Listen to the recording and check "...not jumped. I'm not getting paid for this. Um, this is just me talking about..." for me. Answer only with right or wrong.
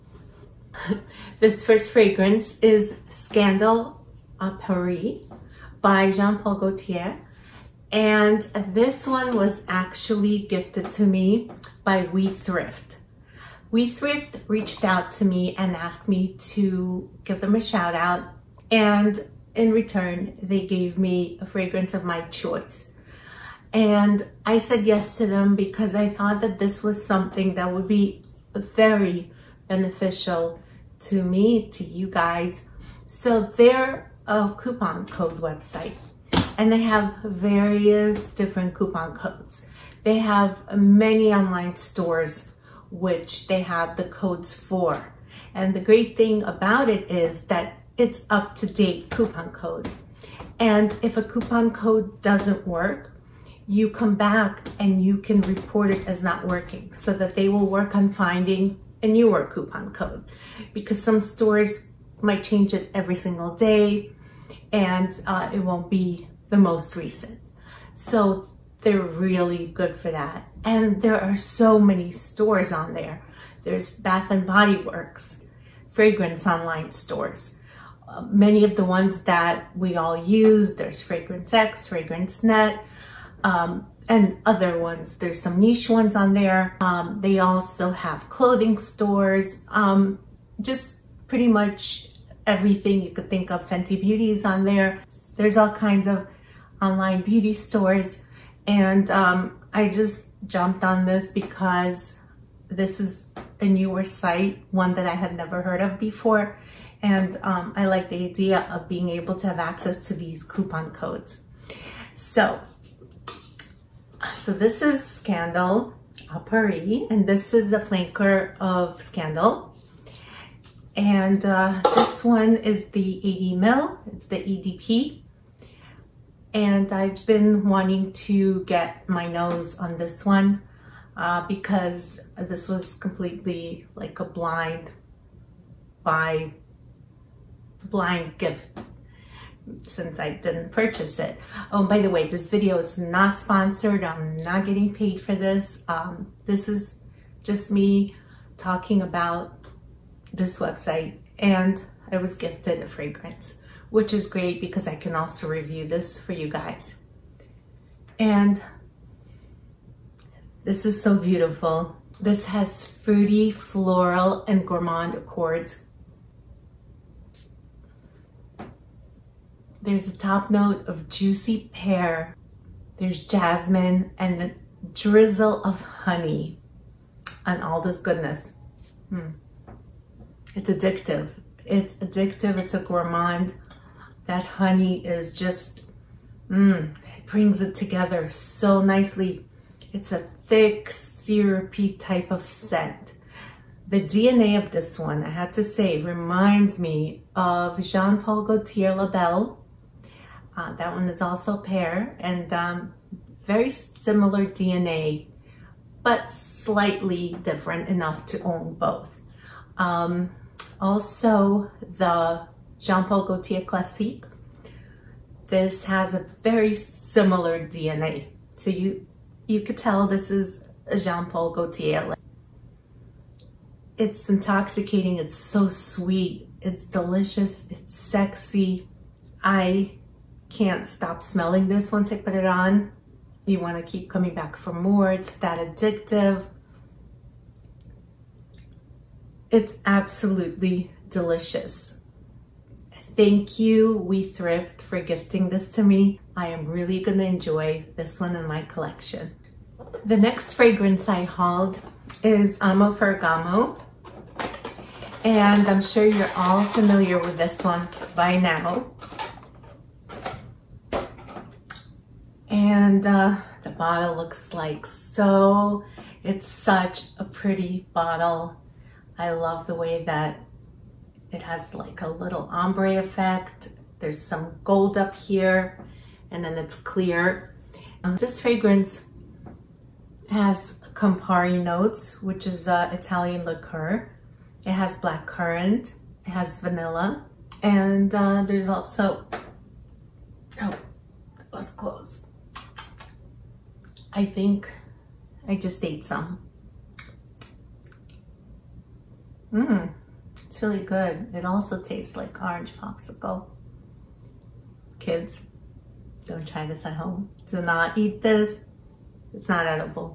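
wrong.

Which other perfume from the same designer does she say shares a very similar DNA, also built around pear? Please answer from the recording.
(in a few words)
La Belle.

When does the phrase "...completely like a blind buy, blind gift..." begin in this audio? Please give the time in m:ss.
2:12.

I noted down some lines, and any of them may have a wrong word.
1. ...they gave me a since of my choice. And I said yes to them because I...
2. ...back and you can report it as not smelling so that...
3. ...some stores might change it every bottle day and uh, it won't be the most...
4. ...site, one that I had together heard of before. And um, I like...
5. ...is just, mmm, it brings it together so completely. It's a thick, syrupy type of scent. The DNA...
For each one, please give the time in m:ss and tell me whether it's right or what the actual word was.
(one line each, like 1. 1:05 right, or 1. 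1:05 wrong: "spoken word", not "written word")
1. 0:20 wrong: "fragrance", not "since"
2. 0:54 wrong: "working", not "smelling"
3. 1:01 wrong: "single", not "bottle"
4. 1:44 wrong: "never", not "together"
5. 3:05 wrong: "nicely", not "completely".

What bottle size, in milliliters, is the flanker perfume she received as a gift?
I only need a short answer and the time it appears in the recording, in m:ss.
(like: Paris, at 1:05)
80, at 2:03.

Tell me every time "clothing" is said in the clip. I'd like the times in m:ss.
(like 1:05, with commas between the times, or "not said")
1:28.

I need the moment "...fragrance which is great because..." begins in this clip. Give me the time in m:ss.
2:32.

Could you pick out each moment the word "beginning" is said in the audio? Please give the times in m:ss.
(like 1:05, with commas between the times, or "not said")
not said.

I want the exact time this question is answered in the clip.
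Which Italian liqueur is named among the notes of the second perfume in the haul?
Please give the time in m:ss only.
4:40.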